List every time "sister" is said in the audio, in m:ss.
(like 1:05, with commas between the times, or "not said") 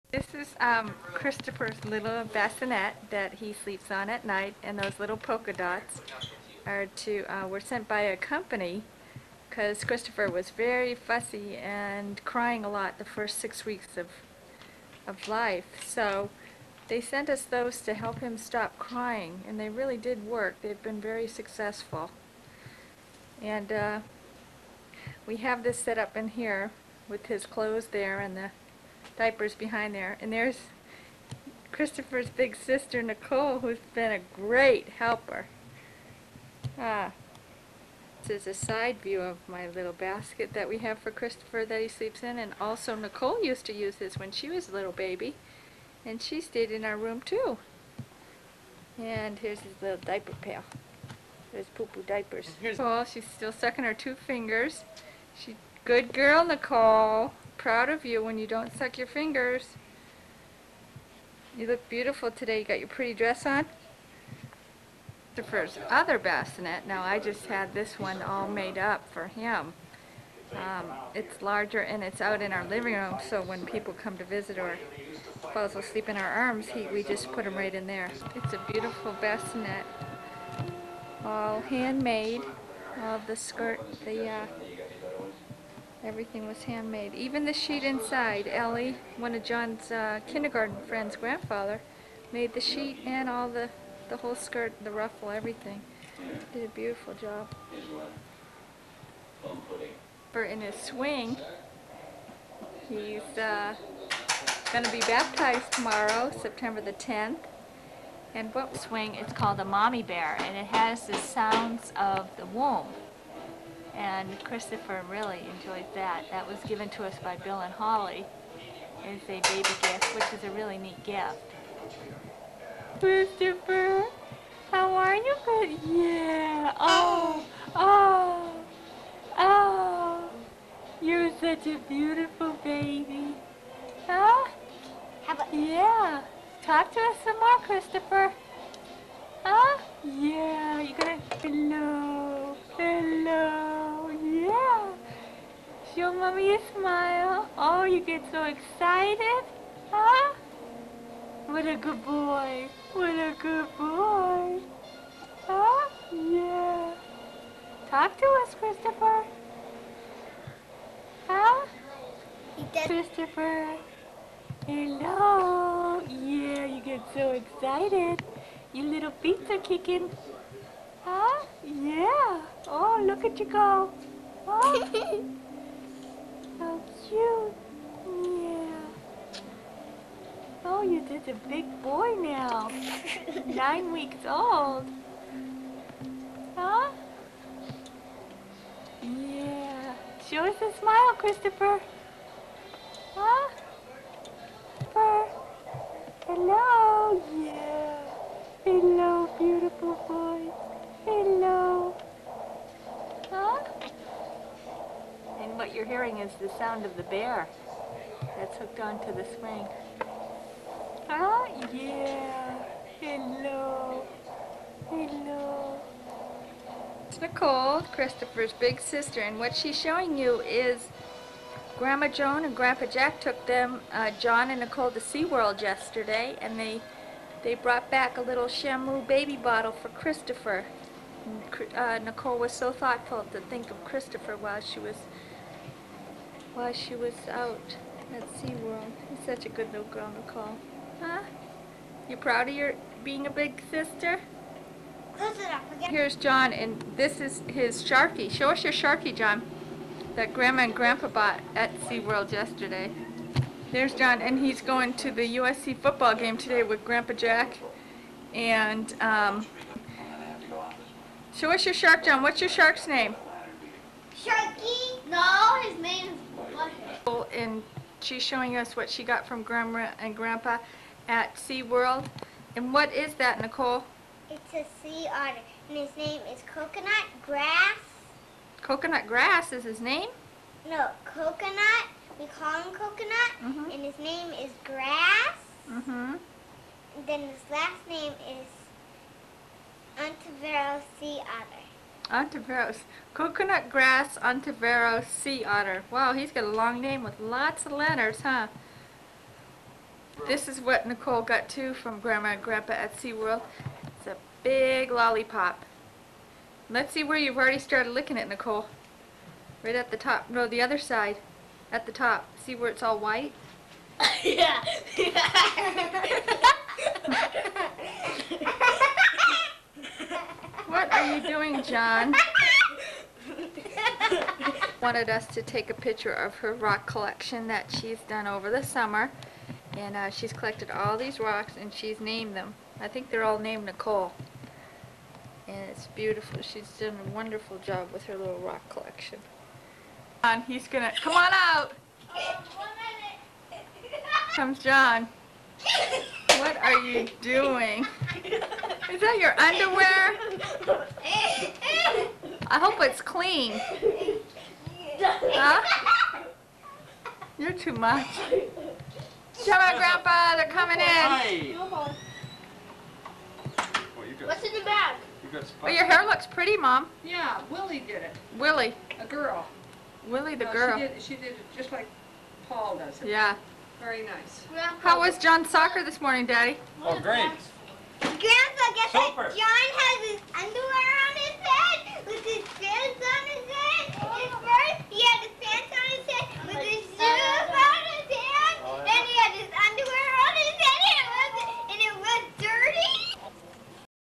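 0:32, 3:38, 4:03.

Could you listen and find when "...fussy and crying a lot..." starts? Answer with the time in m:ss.
0:10.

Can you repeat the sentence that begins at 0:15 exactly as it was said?
So they sent us those to help him stop crying, and they really did work.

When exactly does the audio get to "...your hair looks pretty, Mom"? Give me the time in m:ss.
6:05.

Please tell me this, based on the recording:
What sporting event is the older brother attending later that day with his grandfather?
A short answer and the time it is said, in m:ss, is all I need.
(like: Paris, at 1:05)
USC football game, at 4:15.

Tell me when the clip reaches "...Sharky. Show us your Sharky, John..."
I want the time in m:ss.
4:07.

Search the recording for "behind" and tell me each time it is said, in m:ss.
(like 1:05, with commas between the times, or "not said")
0:29.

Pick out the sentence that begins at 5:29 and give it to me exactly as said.
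And uh, she's collected all these rocks and she's named them.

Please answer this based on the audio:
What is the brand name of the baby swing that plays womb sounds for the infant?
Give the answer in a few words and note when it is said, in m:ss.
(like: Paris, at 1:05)
Mommy Bear, at 1:49.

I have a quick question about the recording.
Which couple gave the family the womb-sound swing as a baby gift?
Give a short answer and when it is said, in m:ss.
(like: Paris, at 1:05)
Bill and Holly, at 1:57.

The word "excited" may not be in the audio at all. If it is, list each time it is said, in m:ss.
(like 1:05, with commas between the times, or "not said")
2:28, 2:47.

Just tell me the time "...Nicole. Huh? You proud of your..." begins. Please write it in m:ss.
4:00.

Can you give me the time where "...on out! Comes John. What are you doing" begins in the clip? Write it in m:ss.
5:41.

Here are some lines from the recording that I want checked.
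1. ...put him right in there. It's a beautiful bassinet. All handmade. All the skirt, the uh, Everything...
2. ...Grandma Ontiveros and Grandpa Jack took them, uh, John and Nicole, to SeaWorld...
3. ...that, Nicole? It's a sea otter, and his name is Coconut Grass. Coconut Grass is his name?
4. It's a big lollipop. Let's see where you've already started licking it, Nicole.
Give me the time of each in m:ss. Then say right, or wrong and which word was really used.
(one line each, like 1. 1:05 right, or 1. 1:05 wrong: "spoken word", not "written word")
1. 1:17 right
2. 3:41 wrong: "Joan", not "Ontiveros"
3. 4:33 right
4. 5:03 right.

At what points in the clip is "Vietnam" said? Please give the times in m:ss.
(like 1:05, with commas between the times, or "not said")
not said.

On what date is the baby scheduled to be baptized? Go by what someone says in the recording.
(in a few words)
September 10.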